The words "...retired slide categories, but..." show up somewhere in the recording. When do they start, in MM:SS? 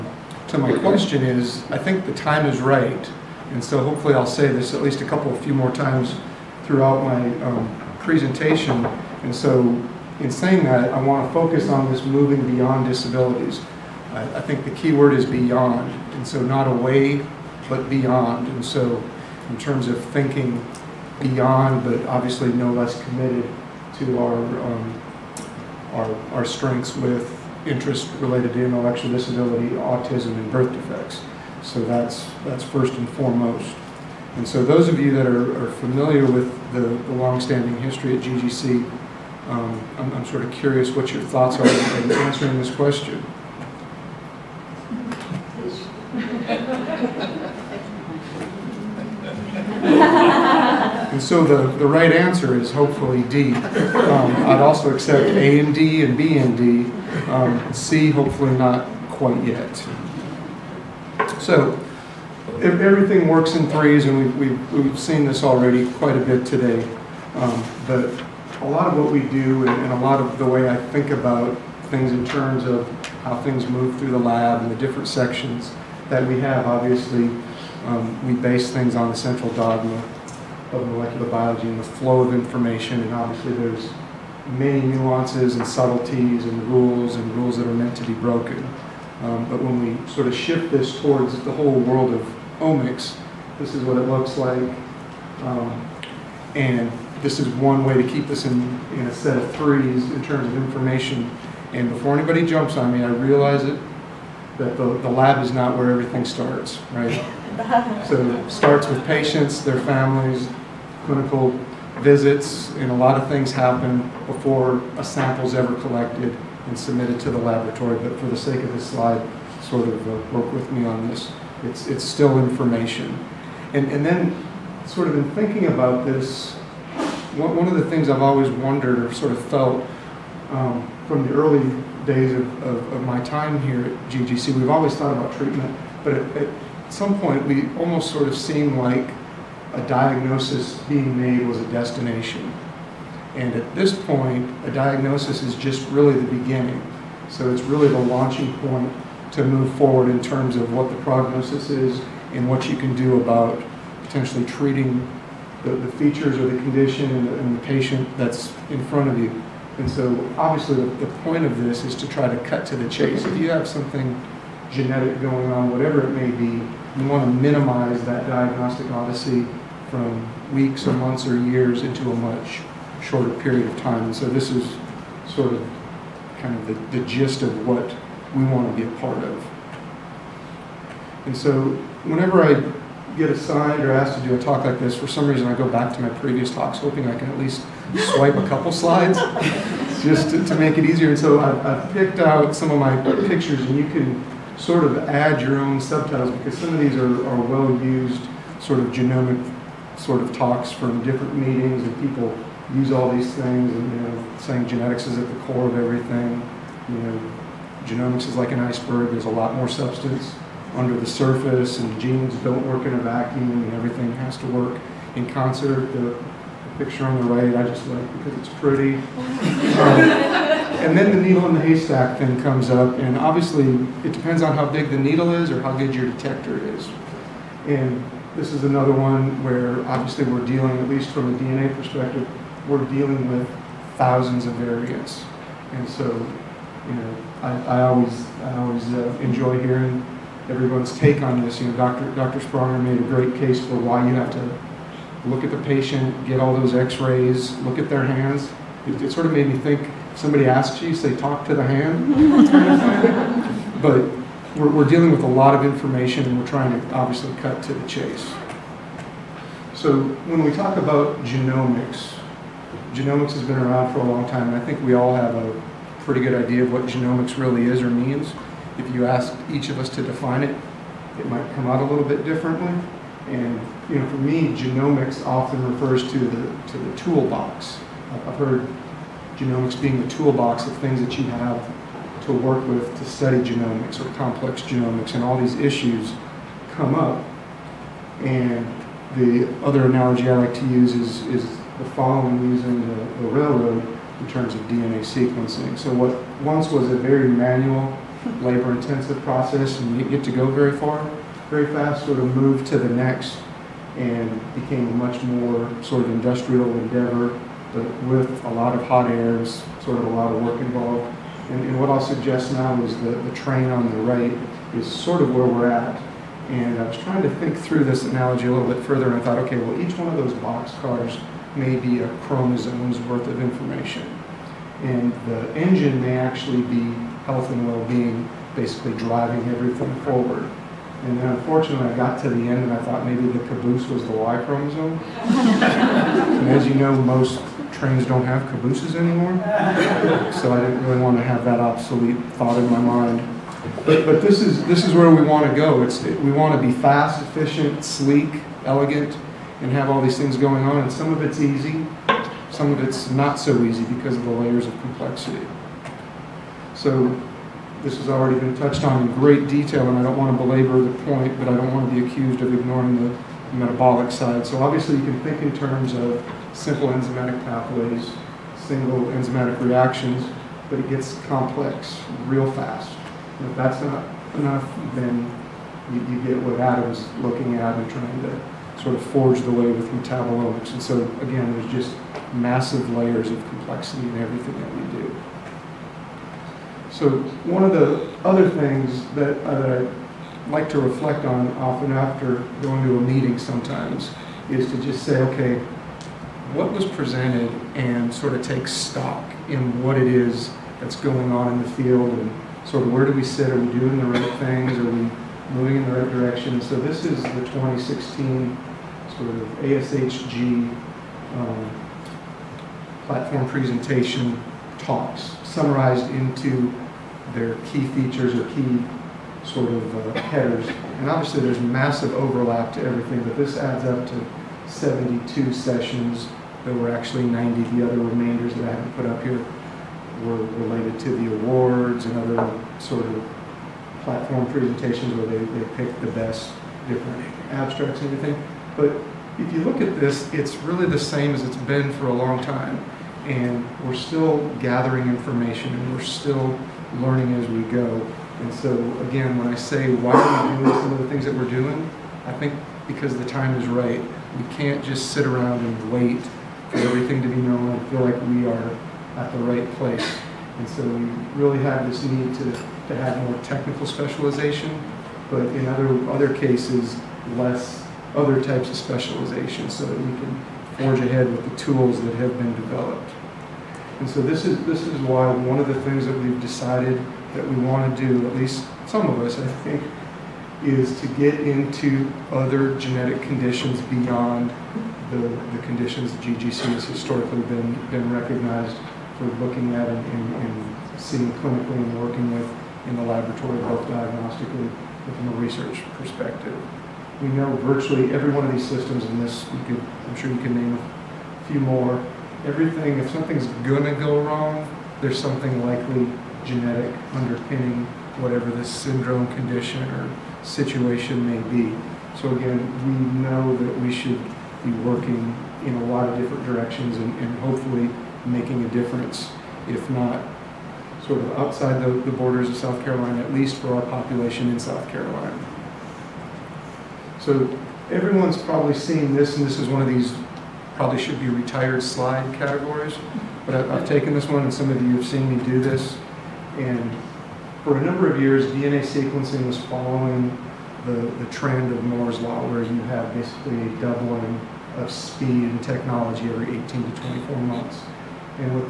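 08:51.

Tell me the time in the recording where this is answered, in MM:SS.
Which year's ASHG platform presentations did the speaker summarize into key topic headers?
06:47.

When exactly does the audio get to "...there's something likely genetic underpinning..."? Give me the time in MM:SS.
08:24.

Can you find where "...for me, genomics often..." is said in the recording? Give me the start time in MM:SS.
04:34.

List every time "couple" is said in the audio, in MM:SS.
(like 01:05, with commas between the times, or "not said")
00:05, 03:08.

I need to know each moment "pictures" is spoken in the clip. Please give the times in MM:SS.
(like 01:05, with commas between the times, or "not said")
03:13, 03:36.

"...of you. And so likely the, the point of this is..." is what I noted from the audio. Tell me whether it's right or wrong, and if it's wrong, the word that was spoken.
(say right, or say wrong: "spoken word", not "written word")
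wrong: "obviously", not "likely".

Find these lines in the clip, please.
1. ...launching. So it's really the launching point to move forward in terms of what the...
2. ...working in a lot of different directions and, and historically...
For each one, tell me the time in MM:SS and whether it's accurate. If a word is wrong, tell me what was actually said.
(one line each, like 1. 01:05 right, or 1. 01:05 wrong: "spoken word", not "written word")
1. 02:26 wrong: "beginning", not "launching"
2. 08:34 wrong: "hopefully", not "historically".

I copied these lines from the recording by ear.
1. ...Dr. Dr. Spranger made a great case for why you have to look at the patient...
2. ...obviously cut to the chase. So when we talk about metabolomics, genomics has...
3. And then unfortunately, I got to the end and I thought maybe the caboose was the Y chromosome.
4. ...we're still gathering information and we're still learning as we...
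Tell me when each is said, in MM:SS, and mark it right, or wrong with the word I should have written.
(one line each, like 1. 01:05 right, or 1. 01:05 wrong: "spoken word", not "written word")
1. 04:01 right
2. 04:16 wrong: "genomics", not "metabolomics"
3. 05:31 right
4. 07:23 right.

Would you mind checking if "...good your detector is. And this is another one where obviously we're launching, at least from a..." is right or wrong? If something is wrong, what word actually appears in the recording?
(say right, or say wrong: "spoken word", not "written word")
wrong: "dealing", not "launching".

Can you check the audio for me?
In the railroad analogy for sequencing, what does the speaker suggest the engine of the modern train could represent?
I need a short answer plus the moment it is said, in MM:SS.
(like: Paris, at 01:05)
health and well-being, at 05:27.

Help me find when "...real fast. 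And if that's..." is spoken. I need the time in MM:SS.
06:12.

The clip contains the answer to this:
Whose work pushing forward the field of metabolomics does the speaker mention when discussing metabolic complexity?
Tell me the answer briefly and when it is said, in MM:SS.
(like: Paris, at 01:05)
Adam, at 06:16.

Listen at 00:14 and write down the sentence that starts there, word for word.
I, I think the key word is beyond.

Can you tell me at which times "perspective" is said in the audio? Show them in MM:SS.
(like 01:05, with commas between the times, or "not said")
03:51, 08:15.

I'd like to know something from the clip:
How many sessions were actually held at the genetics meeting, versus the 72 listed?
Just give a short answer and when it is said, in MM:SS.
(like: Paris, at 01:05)
90, at 07:06.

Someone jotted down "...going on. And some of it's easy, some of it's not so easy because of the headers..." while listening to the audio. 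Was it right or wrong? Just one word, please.
wrong.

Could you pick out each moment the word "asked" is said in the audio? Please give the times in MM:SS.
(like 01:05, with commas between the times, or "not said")
03:03, 04:29.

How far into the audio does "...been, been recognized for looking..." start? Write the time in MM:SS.
08:07.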